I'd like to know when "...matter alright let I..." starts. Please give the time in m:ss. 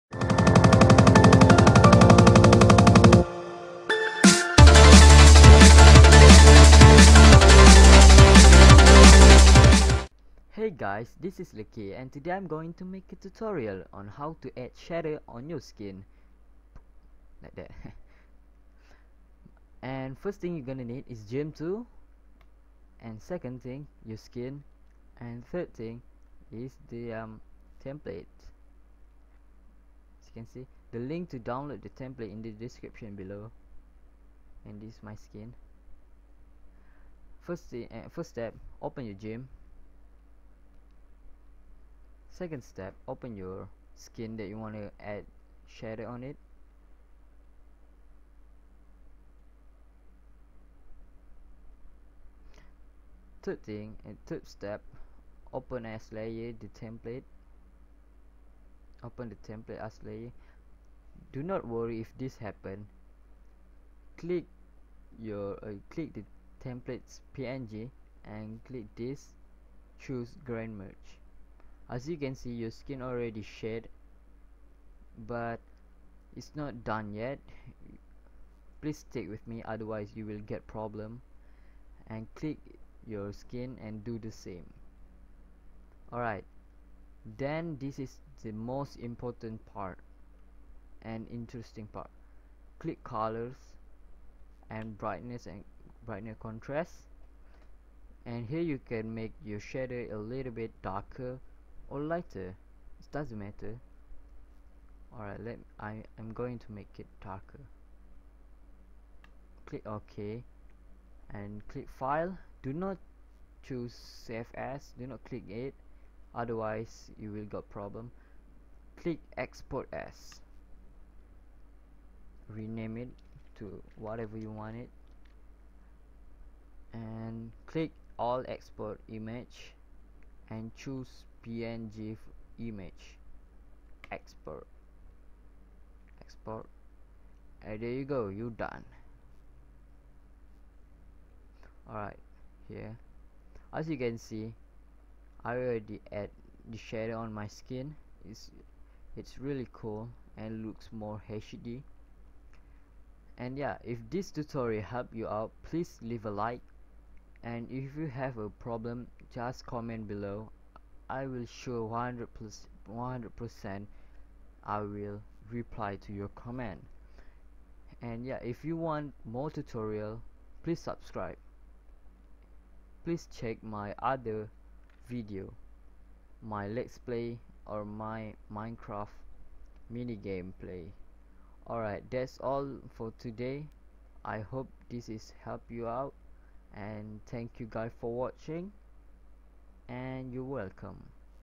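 1:43.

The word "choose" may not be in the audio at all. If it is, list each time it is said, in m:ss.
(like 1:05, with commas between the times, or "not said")
1:10, 1:53, 2:10.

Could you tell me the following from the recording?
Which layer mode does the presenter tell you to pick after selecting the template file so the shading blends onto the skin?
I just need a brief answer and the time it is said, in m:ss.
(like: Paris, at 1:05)
Grain merge, at 1:10.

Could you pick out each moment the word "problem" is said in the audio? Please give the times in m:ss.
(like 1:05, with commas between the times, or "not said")
1:20, 1:57, 2:38.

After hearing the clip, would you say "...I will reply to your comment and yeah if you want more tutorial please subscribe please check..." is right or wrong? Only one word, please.
right.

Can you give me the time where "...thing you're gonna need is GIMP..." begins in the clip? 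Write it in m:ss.
0:20.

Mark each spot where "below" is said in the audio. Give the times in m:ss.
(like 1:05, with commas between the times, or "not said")
0:33, 2:40.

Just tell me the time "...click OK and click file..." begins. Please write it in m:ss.
1:49.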